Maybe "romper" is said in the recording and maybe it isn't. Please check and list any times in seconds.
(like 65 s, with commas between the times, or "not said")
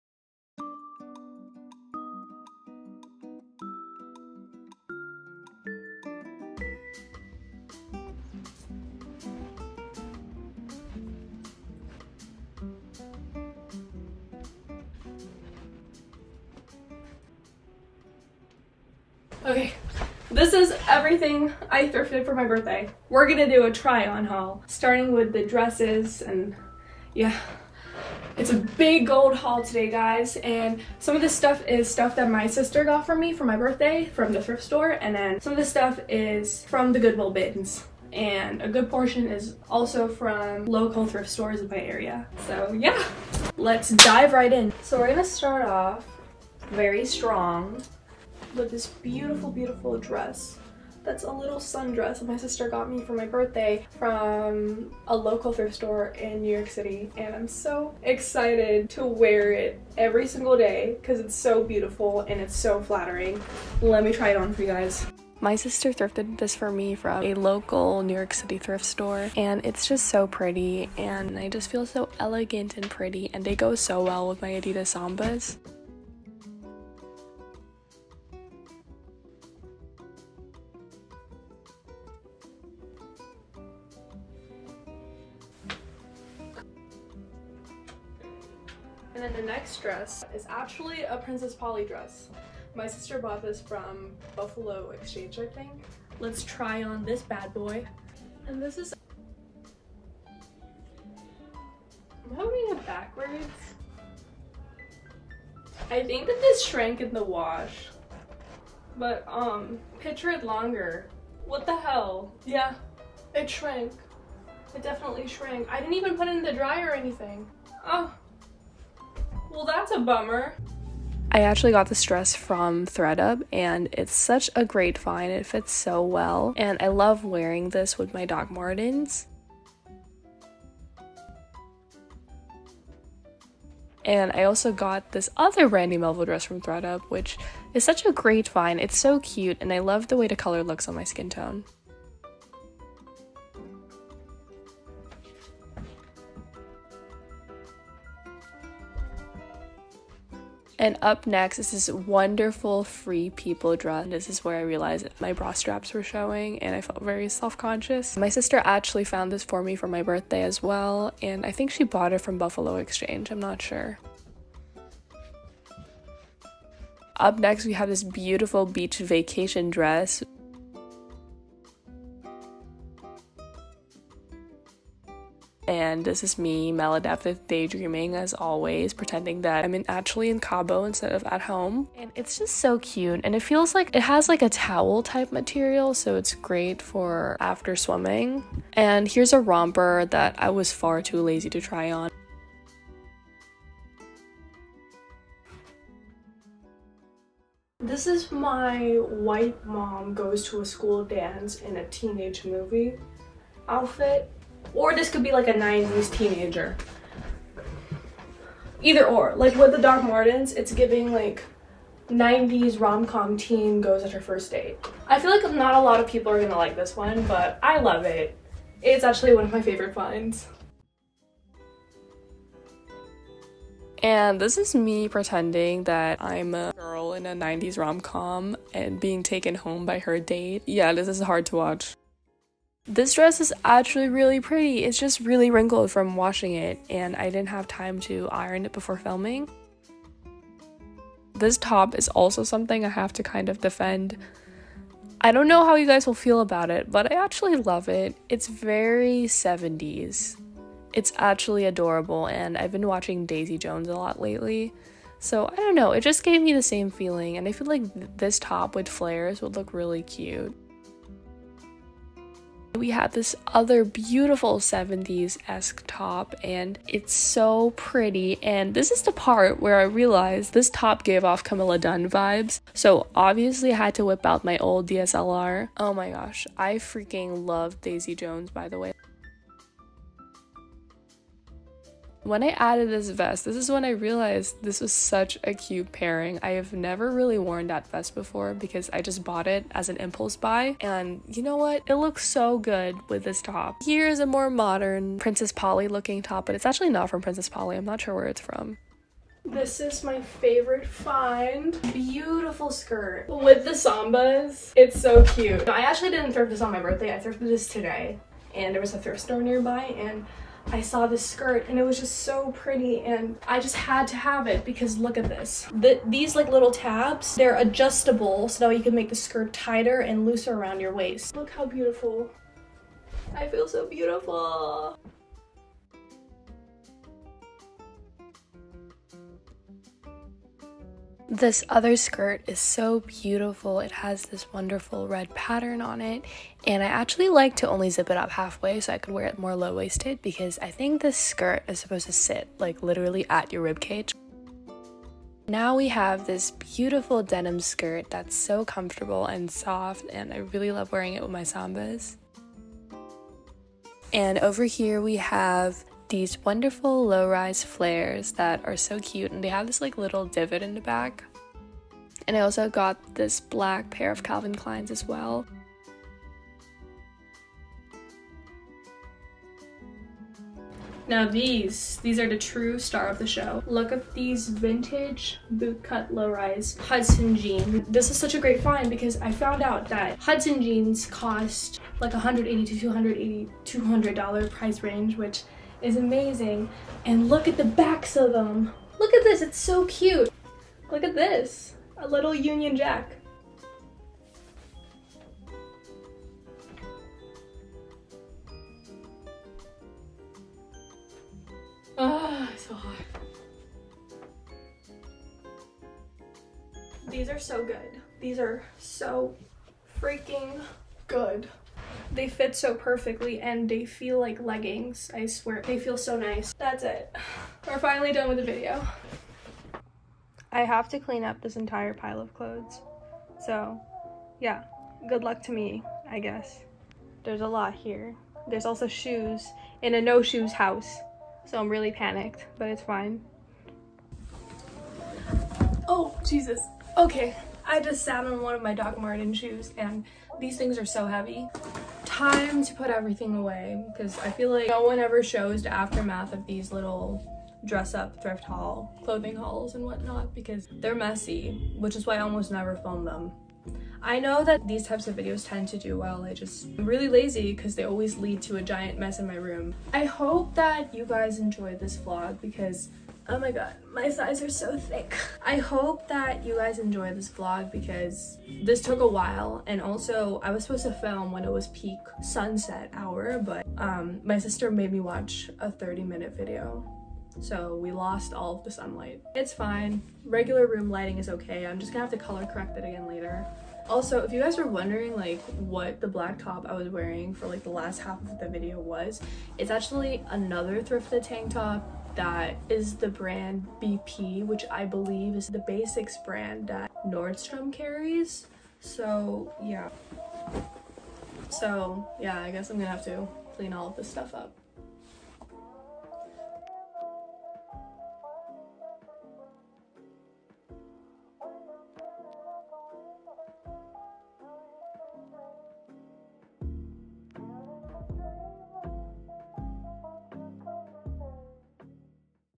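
189 s.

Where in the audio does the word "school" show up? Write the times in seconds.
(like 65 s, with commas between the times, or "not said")
200 s.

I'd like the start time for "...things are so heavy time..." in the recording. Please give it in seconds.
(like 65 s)
440 s.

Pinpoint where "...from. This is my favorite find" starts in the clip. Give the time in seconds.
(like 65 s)
298 s.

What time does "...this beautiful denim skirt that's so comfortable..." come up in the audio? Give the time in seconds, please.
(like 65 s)
346 s.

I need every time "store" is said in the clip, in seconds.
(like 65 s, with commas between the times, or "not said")
34 s, 41 s, 55 s, 68 s, 309 s.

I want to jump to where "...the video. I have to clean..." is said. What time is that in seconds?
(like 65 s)
418 s.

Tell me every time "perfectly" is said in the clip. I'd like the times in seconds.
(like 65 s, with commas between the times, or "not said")
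412 s.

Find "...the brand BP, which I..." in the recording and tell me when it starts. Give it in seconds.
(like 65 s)
492 s.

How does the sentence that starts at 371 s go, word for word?
Now these, these are the true star of the show.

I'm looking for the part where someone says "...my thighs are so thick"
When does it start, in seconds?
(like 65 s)
463 s.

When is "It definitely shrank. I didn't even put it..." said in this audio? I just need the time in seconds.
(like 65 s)
114 s.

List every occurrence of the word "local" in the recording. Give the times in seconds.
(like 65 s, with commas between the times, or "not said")
40 s, 55 s, 67 s.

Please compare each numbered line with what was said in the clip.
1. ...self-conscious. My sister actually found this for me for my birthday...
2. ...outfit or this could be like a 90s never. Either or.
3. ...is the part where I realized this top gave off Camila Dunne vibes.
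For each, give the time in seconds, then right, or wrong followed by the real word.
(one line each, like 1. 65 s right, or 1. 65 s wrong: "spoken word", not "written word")
1. 157 s right
2. 203 s wrong: "teenager", not "never"
3. 268 s right.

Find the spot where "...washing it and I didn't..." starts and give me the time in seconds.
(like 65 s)
236 s.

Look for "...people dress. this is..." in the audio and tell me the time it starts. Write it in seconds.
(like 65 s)
153 s.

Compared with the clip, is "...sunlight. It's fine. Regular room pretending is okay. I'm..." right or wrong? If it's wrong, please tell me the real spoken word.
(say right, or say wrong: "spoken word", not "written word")
wrong: "lighting", not "pretending".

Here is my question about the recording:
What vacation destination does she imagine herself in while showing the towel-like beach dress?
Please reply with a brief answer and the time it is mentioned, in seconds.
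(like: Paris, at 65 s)
Cabo, at 180 s.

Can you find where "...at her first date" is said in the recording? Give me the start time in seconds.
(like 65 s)
214 s.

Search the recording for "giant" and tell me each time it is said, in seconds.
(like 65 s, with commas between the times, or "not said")
458 s.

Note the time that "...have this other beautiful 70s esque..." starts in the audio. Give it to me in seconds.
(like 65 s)
262 s.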